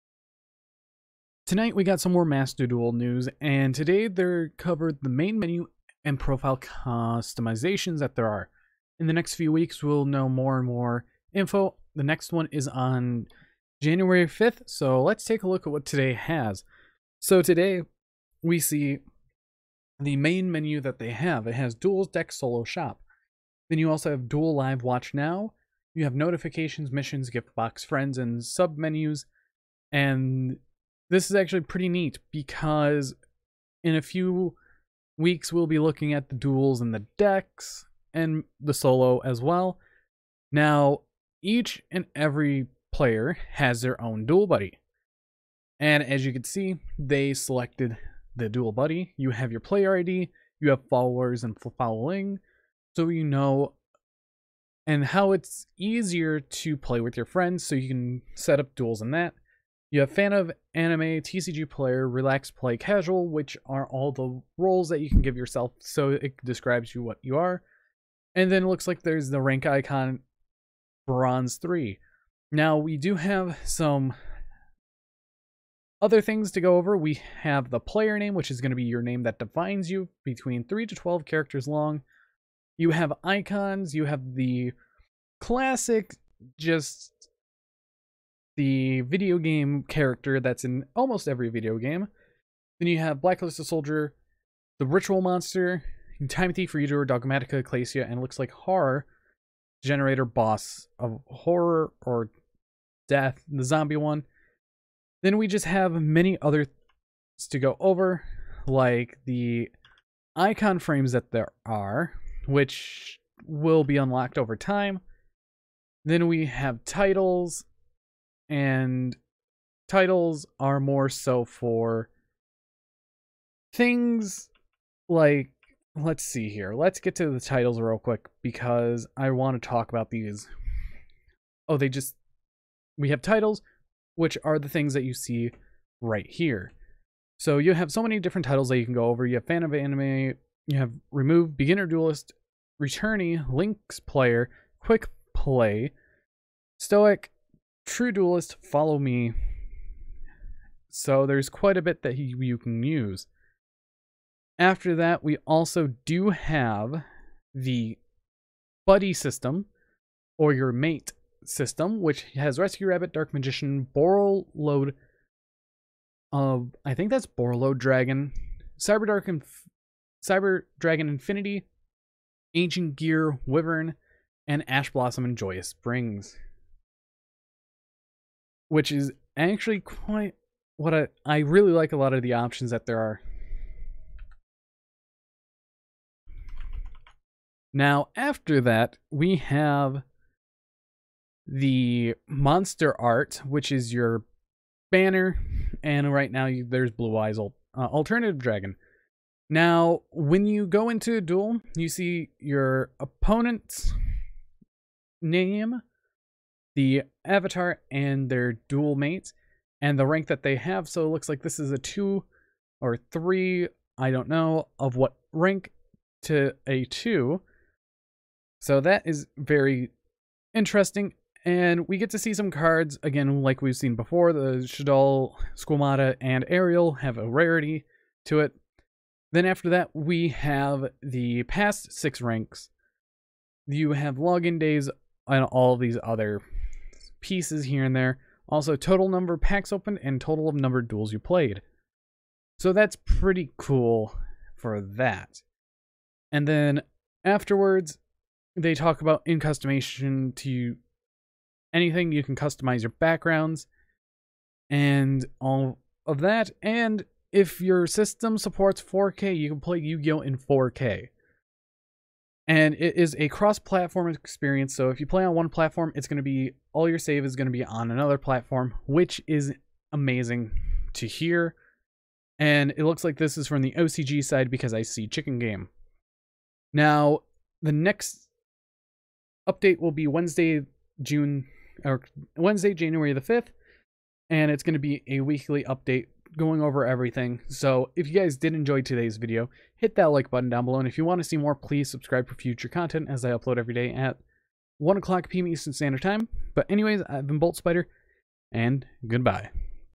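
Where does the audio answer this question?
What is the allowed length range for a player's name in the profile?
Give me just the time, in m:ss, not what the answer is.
1:20.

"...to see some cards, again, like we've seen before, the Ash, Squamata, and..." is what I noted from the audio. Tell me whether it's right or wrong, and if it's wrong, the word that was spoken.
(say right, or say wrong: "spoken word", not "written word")
wrong: "Shadal", not "Ash".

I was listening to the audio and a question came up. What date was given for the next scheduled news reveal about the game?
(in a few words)
January 5th.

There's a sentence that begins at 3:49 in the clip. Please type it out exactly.
Then after that, we have the past six ranks.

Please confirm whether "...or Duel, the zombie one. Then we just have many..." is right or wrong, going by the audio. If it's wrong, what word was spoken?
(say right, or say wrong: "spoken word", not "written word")
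wrong: "Death", not "Duel".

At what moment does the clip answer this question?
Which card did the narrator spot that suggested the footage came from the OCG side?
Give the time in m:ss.
4:35.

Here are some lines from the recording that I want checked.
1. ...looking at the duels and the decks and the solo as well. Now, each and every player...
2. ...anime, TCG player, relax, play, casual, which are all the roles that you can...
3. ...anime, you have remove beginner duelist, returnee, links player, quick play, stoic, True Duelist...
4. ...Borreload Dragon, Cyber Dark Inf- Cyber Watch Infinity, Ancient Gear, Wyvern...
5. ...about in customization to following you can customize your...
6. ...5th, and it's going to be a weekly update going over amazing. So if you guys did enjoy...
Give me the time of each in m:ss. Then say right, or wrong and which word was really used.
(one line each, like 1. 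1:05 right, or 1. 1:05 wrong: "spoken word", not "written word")
1. 0:35 right
2. 1:00 right
3. 2:19 right
4. 2:47 wrong: "Dragon", not "Watch"
5. 4:09 wrong: "anything", not "following"
6. 4:43 wrong: "everything", not "amazing".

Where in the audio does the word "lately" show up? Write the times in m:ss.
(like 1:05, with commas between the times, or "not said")
not said.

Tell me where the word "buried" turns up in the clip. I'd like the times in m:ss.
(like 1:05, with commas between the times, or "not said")
not said.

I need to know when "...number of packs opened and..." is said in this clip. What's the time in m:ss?
3:59.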